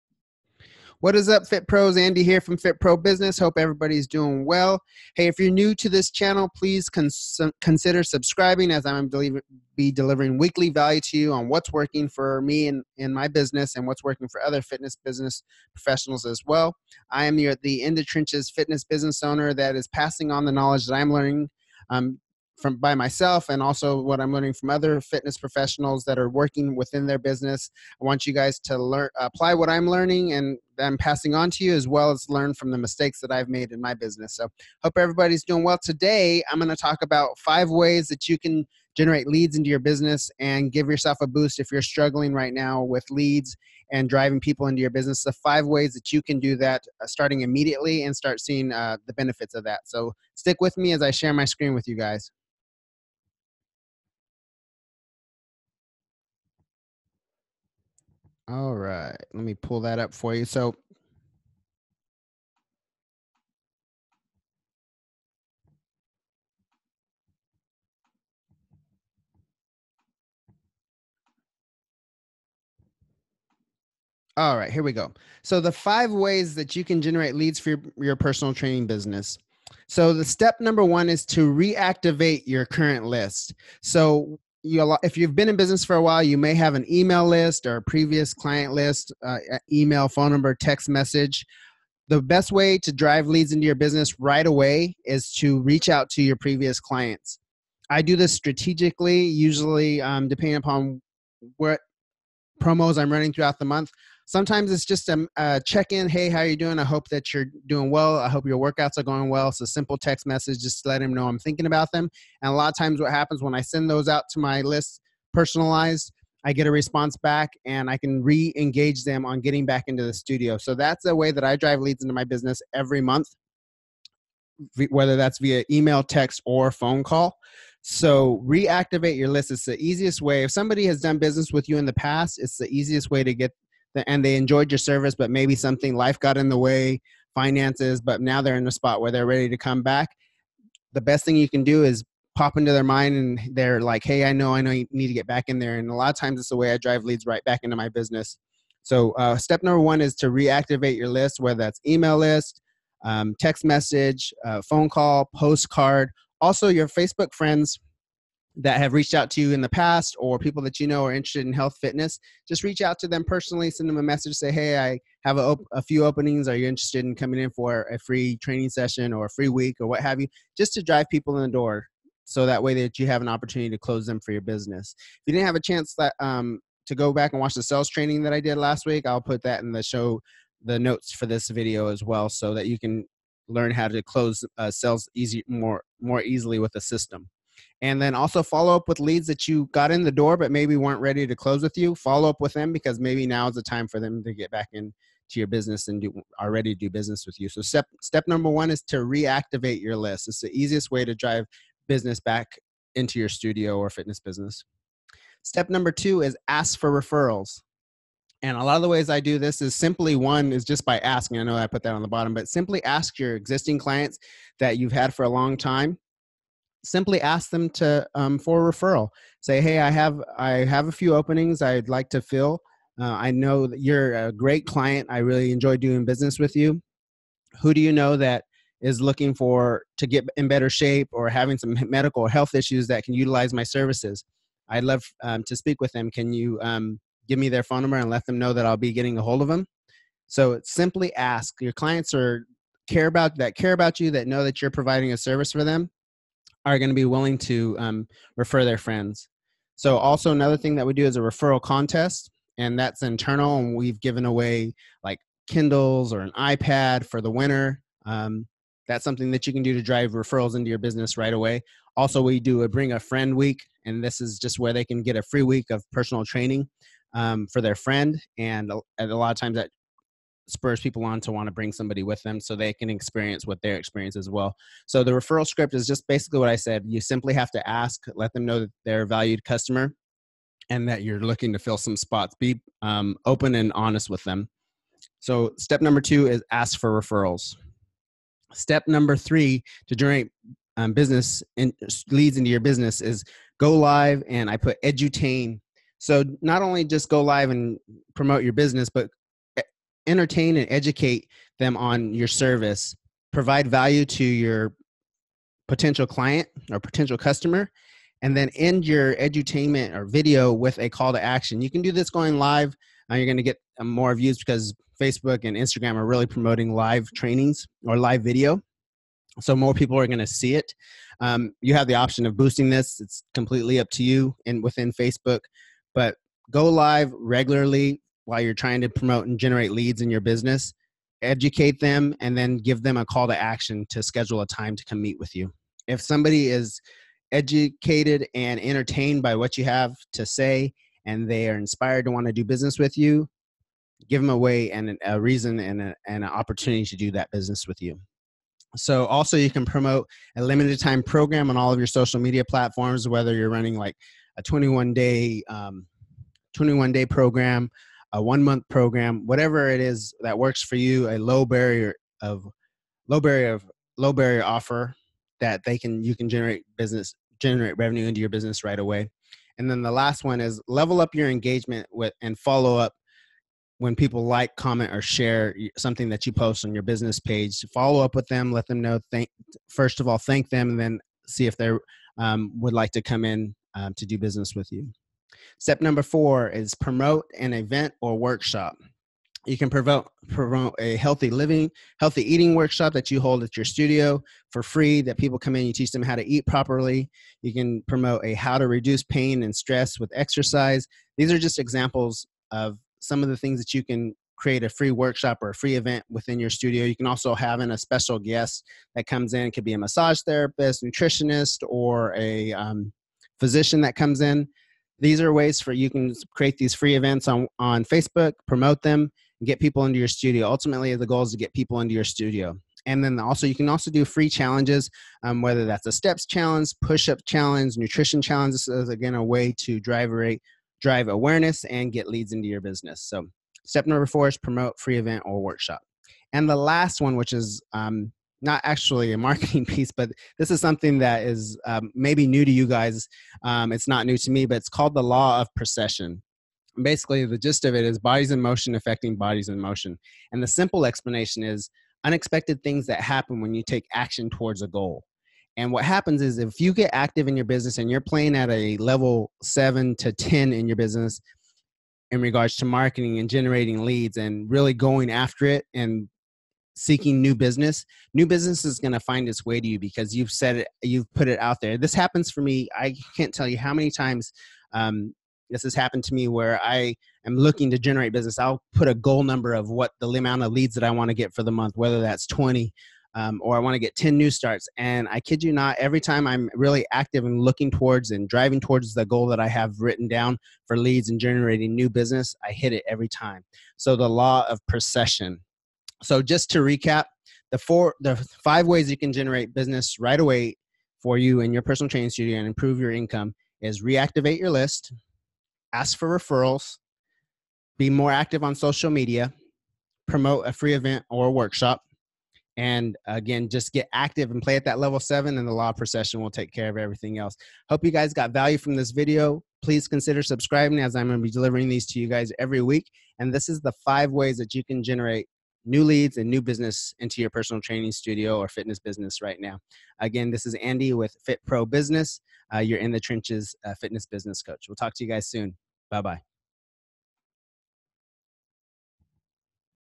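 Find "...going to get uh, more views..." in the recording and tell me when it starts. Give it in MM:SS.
05:13.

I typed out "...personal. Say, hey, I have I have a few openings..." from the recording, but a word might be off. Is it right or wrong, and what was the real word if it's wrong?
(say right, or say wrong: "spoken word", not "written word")
wrong: "referral", not "personal".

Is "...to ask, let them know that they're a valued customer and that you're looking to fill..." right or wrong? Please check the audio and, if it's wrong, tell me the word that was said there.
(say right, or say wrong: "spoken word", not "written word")
right.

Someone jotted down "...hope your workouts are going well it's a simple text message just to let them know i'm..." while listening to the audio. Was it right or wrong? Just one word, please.
right.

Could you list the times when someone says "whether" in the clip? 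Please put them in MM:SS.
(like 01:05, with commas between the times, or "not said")
02:04, 02:31, 05:53, 07:05, 08:01.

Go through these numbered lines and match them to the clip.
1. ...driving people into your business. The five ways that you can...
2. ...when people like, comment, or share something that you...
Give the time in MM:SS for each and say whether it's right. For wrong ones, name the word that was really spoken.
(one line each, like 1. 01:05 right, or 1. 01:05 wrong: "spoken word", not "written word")
1. 00:44 right
2. 06:13 right.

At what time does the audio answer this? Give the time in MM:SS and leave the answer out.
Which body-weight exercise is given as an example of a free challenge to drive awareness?
07:06.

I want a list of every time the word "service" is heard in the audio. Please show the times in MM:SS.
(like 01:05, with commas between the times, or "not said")
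02:14, 03:53, 04:05, 05:02.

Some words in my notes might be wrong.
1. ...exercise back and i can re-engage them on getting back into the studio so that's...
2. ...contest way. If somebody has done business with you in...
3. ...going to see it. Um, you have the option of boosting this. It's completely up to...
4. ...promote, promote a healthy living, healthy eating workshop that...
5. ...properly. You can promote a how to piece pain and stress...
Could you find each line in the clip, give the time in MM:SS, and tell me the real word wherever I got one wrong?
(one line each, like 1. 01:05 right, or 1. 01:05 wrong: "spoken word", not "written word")
1. 01:56 wrong: "response", not "exercise"
2. 02:09 wrong: "easiest", not "contest"
3. 05:20 right
4. 06:29 right
5. 06:36 wrong: "reduce", not "piece".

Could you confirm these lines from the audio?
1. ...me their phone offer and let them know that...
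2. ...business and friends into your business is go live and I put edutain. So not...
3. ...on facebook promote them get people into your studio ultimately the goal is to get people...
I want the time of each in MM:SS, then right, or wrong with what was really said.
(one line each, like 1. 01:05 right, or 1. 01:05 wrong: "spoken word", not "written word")
1. 03:57 wrong: "number", not "offer"
2. 04:50 wrong: "leads", not "friends"
3. 06:57 right.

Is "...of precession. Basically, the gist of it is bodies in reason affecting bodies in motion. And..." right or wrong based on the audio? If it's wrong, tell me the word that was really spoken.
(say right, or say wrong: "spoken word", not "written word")
wrong: "motion", not "reason".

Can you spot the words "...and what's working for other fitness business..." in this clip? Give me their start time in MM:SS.
00:13.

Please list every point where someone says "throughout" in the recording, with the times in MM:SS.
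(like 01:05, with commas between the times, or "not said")
01:43.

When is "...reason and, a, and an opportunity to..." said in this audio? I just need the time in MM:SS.
05:45.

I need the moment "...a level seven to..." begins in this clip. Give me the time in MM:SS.
07:38.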